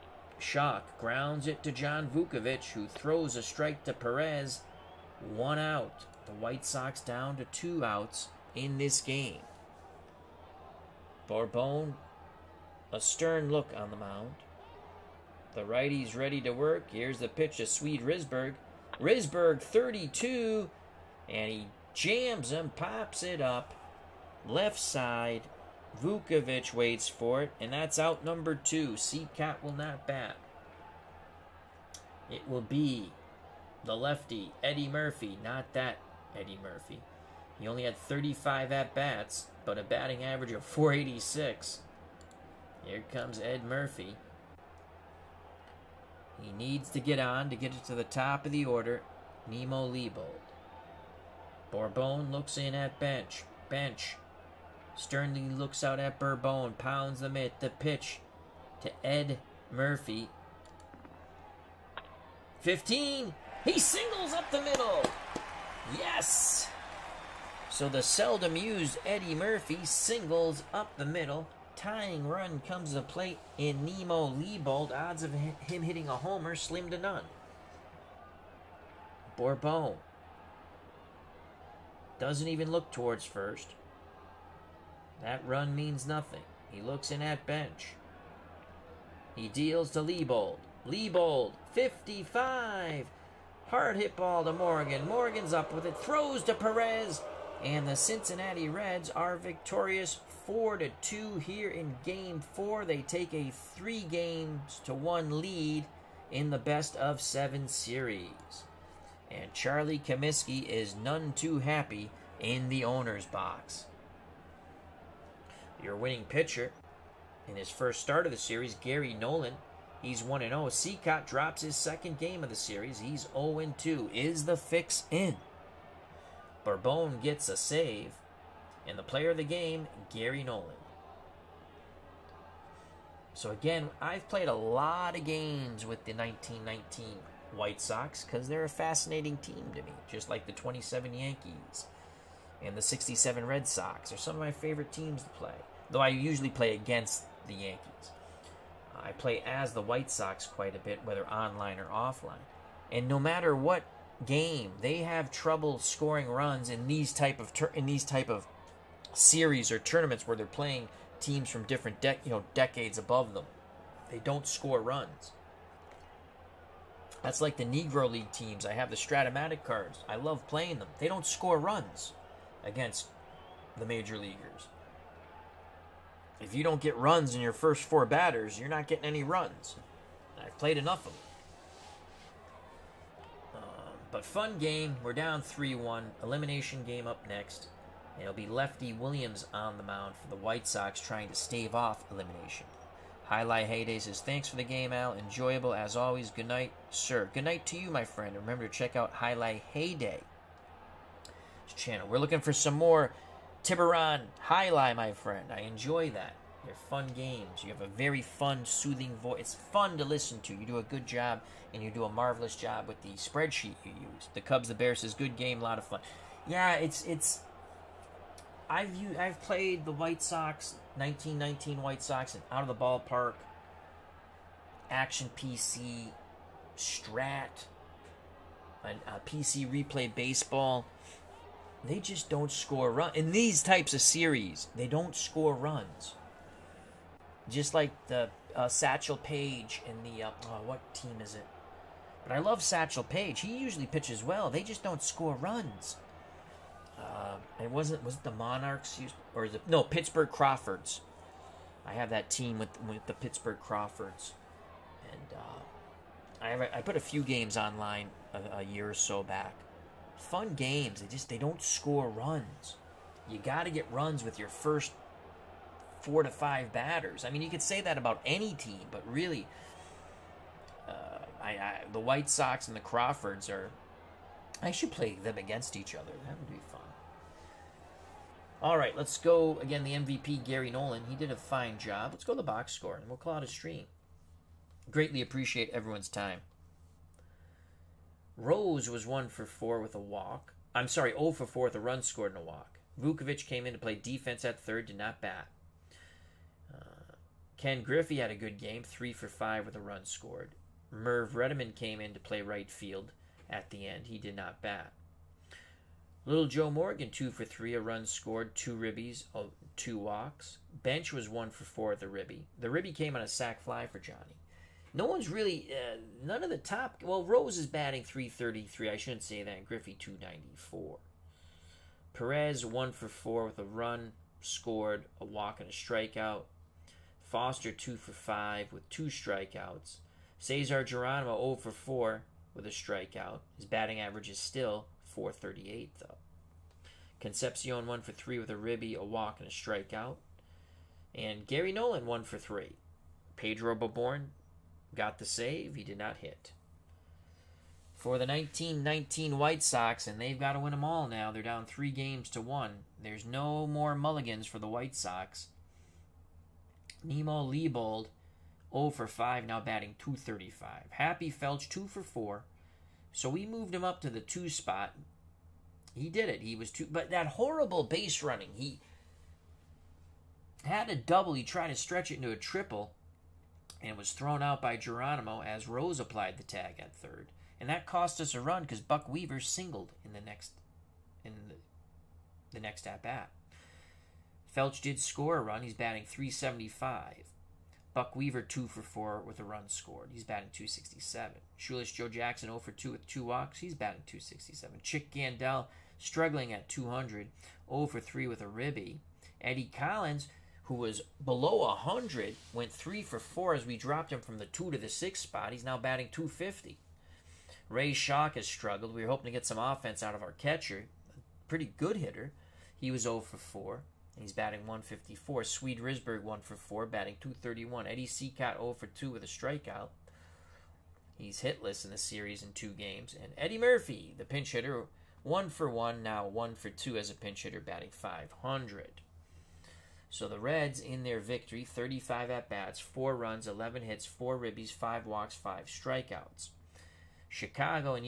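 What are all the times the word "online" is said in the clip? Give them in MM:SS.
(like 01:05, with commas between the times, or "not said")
02:31, 04:17.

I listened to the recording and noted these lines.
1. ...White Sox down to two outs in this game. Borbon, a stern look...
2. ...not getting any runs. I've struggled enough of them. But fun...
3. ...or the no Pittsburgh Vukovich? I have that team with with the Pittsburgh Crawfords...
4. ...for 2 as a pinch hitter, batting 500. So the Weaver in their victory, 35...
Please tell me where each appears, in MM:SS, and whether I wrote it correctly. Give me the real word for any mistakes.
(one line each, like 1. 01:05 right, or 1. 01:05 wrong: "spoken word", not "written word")
1. 00:06 right
2. 02:58 wrong: "played", not "struggled"
3. 04:09 wrong: "Crawfords", not "Vukovich"
4. 07:06 wrong: "Reds", not "Weaver".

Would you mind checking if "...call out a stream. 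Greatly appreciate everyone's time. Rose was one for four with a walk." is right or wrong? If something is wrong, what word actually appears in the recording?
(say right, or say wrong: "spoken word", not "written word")
right.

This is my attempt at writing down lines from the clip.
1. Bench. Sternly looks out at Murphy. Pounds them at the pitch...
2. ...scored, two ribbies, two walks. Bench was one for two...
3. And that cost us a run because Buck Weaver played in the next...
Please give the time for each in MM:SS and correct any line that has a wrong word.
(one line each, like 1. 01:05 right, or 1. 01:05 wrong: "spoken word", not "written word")
1. 00:53 wrong: "Borbon", not "Murphy"
2. 05:08 wrong: "four", not "two"
3. 06:17 wrong: "singled", not "played".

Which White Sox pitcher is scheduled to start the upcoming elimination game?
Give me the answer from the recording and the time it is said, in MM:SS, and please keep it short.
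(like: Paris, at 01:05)
Lefty Williams, at 03:08.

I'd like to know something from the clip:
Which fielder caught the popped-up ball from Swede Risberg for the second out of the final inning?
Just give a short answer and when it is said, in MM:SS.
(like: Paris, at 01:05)
John Vukovich, at 00:25.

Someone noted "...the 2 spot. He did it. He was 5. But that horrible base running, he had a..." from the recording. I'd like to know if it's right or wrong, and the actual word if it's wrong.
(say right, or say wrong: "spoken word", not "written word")
wrong: "2", not "5".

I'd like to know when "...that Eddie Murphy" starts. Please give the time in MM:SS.
00:35.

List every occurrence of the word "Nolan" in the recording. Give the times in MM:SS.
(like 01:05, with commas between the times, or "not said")
01:59, 02:10, 04:40, 05:41.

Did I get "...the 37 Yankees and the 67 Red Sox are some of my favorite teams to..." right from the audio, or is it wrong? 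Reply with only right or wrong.
wrong.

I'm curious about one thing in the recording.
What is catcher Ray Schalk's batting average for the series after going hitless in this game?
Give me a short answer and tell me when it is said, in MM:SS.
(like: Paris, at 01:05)
154, at 06:54.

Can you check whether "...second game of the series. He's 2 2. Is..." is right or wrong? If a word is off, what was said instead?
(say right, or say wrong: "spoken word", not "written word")
wrong: "0", not "2".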